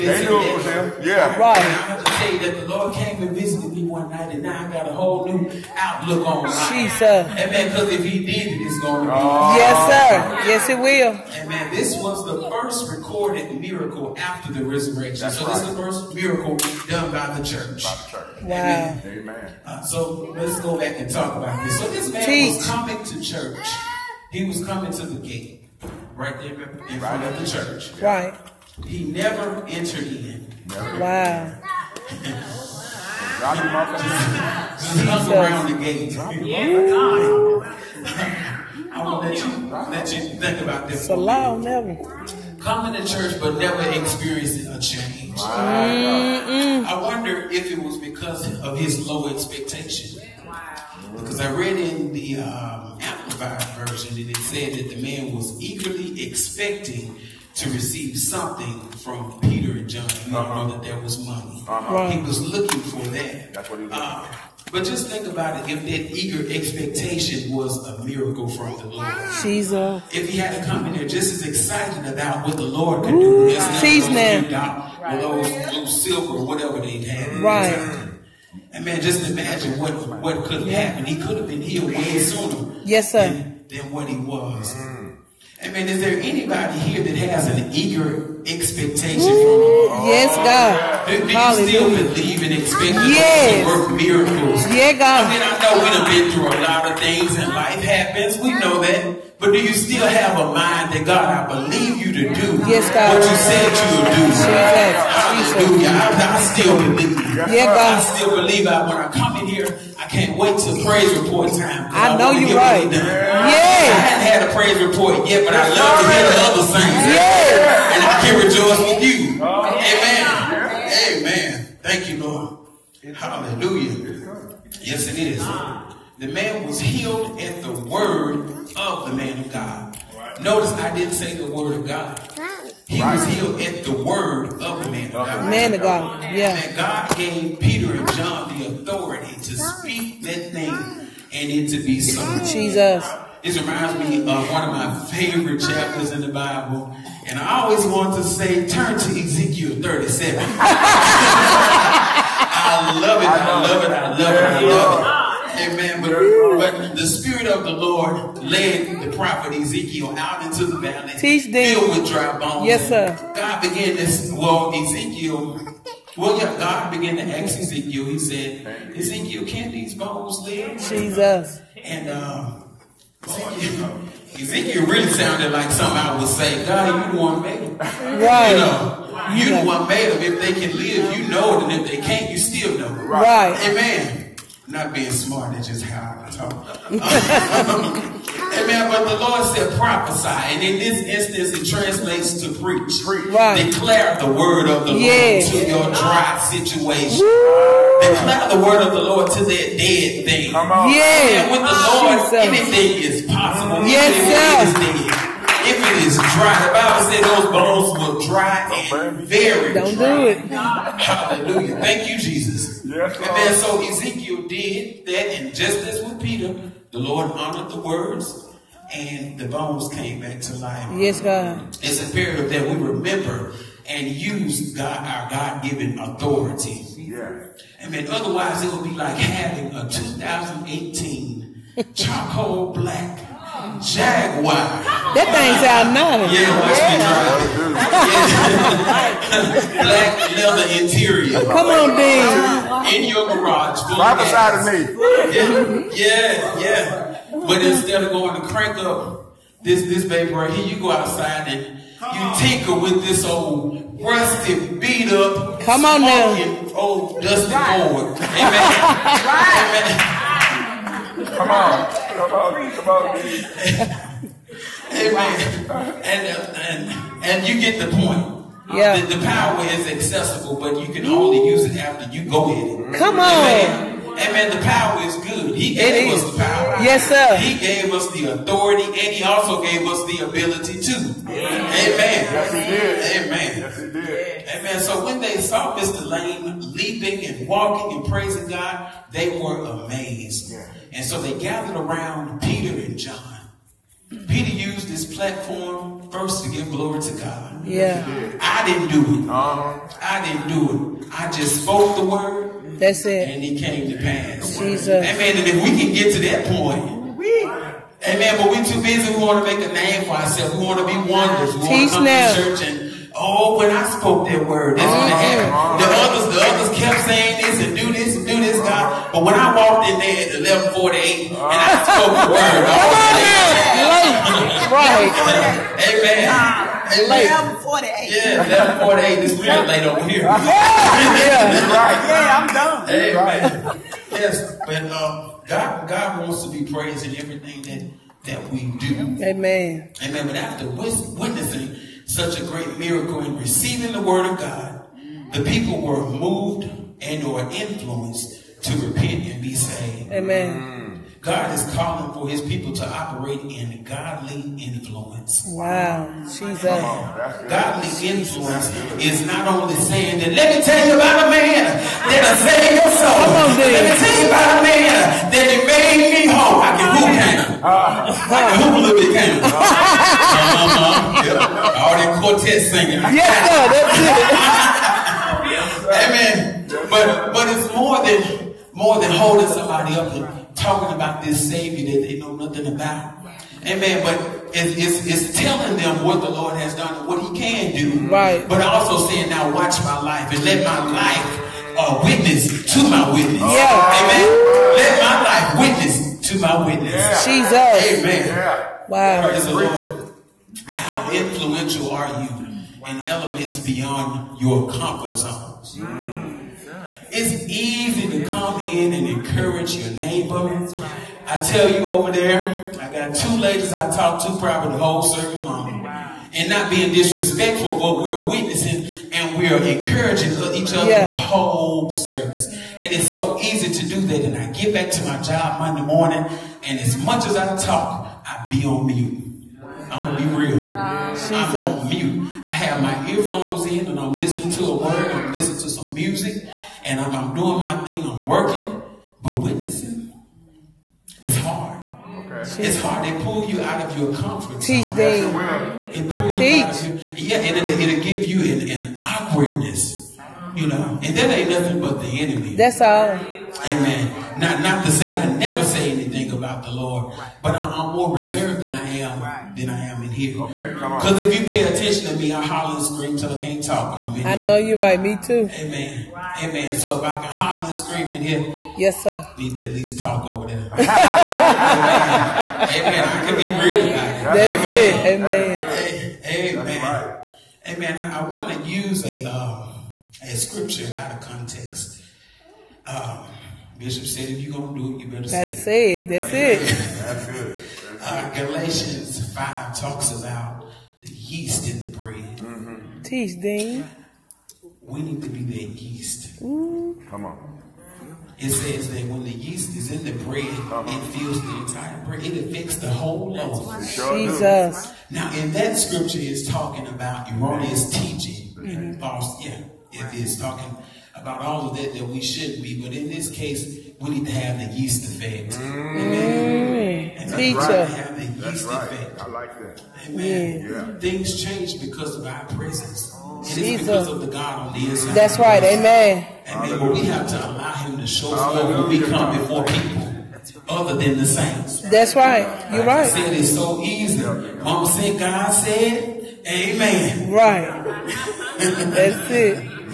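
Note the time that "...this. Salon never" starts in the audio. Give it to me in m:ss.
0:40.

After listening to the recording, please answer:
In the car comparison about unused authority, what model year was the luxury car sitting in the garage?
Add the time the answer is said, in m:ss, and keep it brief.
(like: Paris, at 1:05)
2018, at 3:49.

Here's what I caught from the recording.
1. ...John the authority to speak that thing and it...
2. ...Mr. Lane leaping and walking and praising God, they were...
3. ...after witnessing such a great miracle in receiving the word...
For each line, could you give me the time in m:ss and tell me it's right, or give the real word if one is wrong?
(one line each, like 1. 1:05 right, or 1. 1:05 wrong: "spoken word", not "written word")
1. 2:18 right
2. 4:45 right
3. 5:40 right.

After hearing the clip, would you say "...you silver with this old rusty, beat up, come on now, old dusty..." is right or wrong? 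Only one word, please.
wrong.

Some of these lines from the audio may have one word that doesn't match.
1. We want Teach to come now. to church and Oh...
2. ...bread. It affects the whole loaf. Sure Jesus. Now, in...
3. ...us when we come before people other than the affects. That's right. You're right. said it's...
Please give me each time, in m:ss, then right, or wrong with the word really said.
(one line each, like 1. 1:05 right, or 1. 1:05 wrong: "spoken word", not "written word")
1. 5:11 right
2. 8:22 right
3. 8:48 wrong: "saints", not "affects".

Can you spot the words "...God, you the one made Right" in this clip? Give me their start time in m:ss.
2:56.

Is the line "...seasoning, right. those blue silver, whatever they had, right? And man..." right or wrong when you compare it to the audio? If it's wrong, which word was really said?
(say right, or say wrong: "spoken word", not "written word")
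right.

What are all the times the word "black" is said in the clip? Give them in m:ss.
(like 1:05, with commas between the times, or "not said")
3:52, 3:59.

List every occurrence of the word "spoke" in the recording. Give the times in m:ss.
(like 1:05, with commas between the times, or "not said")
5:01, 5:13, 5:21.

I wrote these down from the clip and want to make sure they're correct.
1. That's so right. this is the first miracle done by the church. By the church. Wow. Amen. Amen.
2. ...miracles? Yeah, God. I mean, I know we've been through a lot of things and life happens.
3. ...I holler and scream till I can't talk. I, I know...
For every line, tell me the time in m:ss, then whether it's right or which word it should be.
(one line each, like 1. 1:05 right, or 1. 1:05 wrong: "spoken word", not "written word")
1. 0:15 right
2. 1:33 right
3. 7:42 right.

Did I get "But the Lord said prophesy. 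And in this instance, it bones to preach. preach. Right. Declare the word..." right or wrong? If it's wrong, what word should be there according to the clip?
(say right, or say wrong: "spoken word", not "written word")
wrong: "translates", not "bones".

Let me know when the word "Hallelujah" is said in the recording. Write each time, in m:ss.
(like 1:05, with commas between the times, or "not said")
1:45, 2:03, 3:30.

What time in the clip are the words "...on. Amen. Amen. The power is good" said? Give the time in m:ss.
4:33.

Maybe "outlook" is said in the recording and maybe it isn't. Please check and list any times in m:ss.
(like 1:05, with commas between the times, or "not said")
0:05.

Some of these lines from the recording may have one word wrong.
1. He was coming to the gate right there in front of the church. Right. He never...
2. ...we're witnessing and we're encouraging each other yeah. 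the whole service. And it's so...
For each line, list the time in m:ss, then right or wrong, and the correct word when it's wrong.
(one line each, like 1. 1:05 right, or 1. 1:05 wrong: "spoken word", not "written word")
1. 0:24 right
2. 6:58 right.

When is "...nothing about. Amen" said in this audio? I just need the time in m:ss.
6:22.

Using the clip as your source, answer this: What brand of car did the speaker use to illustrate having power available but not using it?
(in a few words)
Jaguar.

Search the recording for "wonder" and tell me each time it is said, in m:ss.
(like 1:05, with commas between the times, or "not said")
0:47, 5:11.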